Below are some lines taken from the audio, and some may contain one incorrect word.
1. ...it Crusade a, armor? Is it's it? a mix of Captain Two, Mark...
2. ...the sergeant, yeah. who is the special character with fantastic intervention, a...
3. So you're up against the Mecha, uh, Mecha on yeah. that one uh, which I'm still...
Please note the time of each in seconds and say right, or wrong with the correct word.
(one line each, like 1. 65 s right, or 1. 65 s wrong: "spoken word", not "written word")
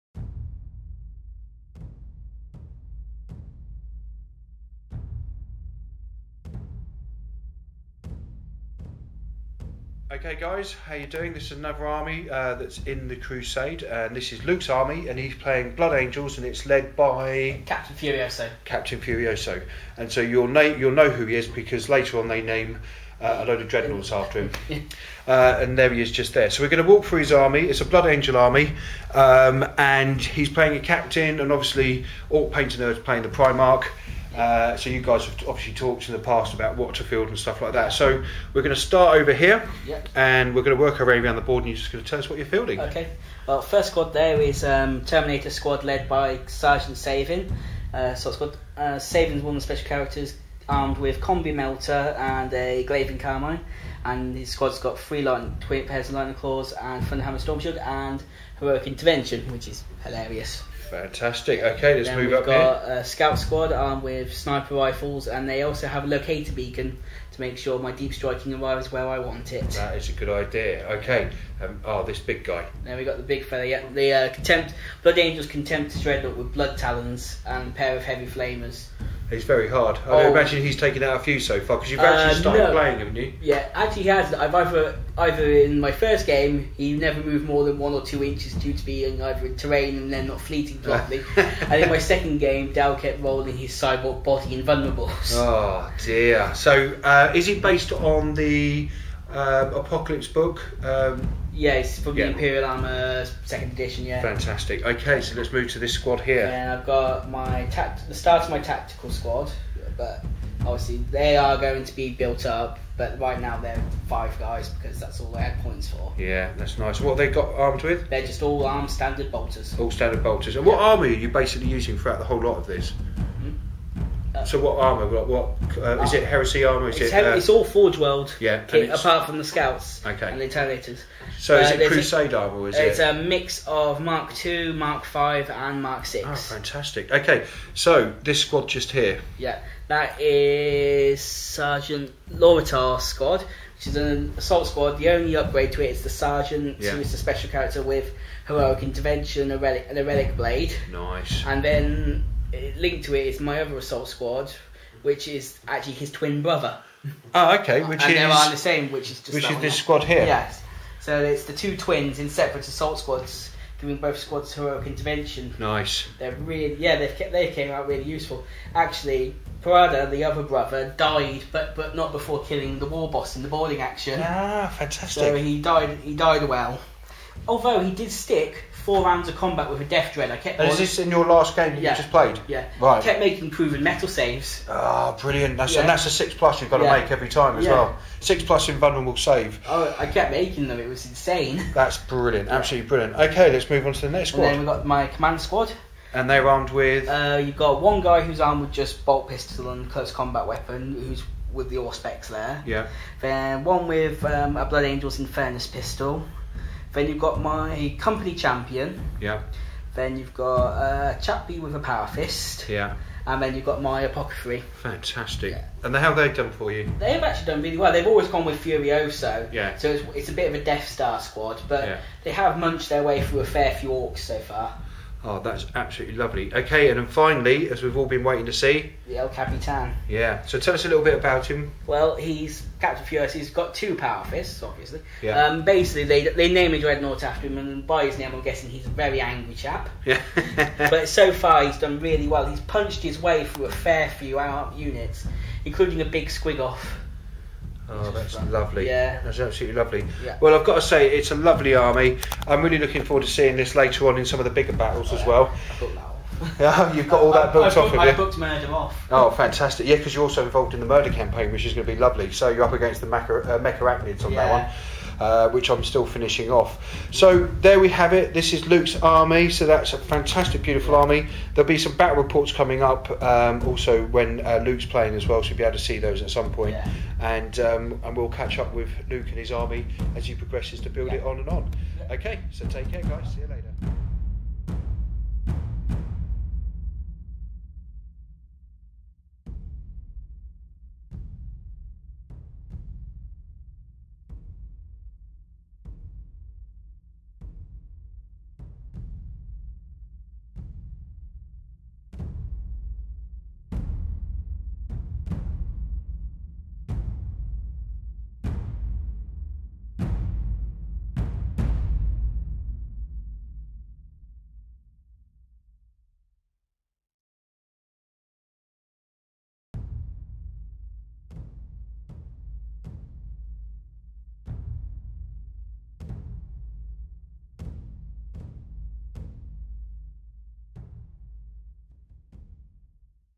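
1. 131 s wrong: "Mark", not "Captain"
2. 146 s wrong: "heroic", not "fantastic"
3. 262 s right.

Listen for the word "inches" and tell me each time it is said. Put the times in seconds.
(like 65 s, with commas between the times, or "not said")
88 s.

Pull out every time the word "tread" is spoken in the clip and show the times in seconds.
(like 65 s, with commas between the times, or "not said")
not said.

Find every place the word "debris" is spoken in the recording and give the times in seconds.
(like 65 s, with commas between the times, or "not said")
not said.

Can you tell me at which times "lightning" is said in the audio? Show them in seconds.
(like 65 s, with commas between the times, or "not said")
56 s.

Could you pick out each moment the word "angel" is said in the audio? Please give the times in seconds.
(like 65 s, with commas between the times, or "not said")
15 s, 28 s, 75 s, 204 s.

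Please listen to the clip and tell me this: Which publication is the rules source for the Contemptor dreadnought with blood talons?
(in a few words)
Imperial Armour second edition.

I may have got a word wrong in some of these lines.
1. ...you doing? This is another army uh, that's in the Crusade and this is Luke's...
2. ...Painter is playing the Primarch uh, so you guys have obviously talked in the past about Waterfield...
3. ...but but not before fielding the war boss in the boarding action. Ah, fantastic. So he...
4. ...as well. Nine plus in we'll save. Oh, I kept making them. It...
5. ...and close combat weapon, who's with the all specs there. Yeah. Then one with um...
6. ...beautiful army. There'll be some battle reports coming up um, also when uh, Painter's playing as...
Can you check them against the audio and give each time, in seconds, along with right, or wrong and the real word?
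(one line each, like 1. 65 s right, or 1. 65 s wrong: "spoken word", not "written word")
1. 10 s right
2. 32 s right
3. 171 s wrong: "killing", not "fielding"
4. 187 s wrong: "Six", not "Nine"
5. 199 s right
6. 270 s wrong: "Luke", not "Painter".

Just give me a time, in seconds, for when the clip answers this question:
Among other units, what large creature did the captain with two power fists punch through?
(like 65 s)
246 s.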